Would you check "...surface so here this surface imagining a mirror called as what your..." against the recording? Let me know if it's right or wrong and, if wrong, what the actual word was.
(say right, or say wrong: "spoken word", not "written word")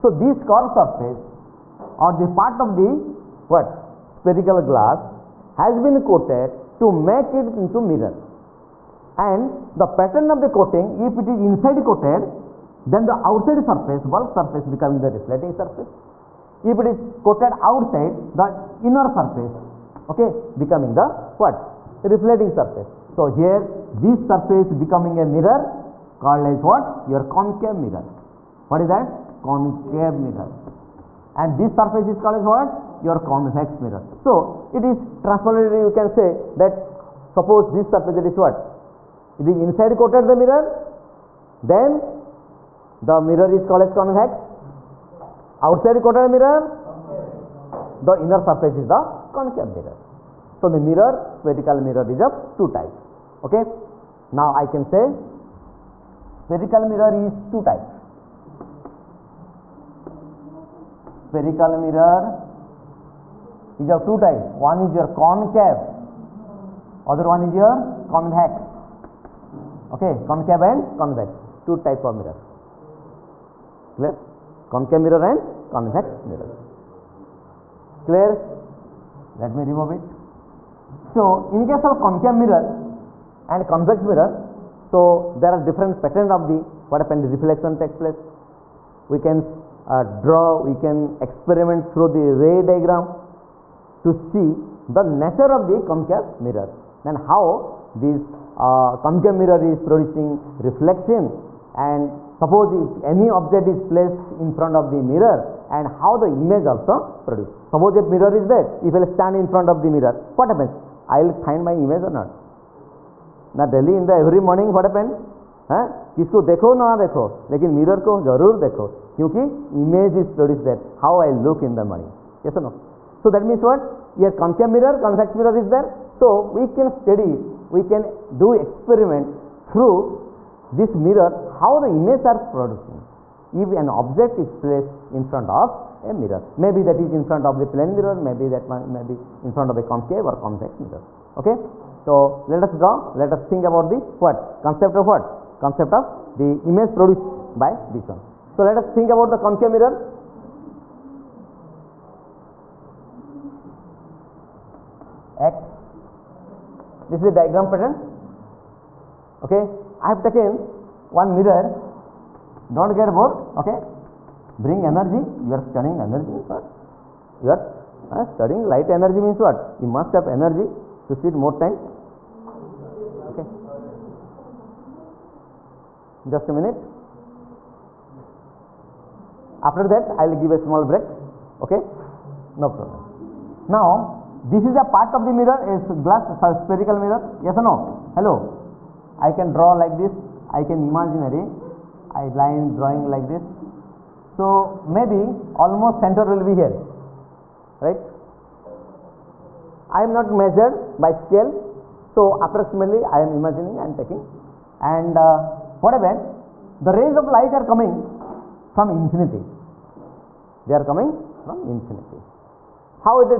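wrong: "becoming", not "imagining".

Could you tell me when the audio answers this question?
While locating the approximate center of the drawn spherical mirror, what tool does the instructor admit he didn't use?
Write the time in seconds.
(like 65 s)
201 s.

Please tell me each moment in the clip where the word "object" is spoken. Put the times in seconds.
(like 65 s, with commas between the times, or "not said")
103 s, 134 s.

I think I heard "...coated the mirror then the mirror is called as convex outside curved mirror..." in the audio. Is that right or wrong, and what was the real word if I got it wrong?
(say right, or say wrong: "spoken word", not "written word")
wrong: "coated", not "curved".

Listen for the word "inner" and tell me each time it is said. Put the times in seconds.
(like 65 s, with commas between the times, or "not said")
18 s, 48 s.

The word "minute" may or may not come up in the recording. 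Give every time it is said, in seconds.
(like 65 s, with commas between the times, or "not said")
176 s.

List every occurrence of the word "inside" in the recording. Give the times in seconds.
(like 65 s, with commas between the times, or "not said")
11 s, 39 s.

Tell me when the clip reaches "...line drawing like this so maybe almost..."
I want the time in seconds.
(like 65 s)
192 s.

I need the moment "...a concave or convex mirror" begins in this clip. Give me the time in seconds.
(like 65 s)
139 s.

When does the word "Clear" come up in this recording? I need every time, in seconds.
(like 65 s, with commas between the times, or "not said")
73 s, 78 s.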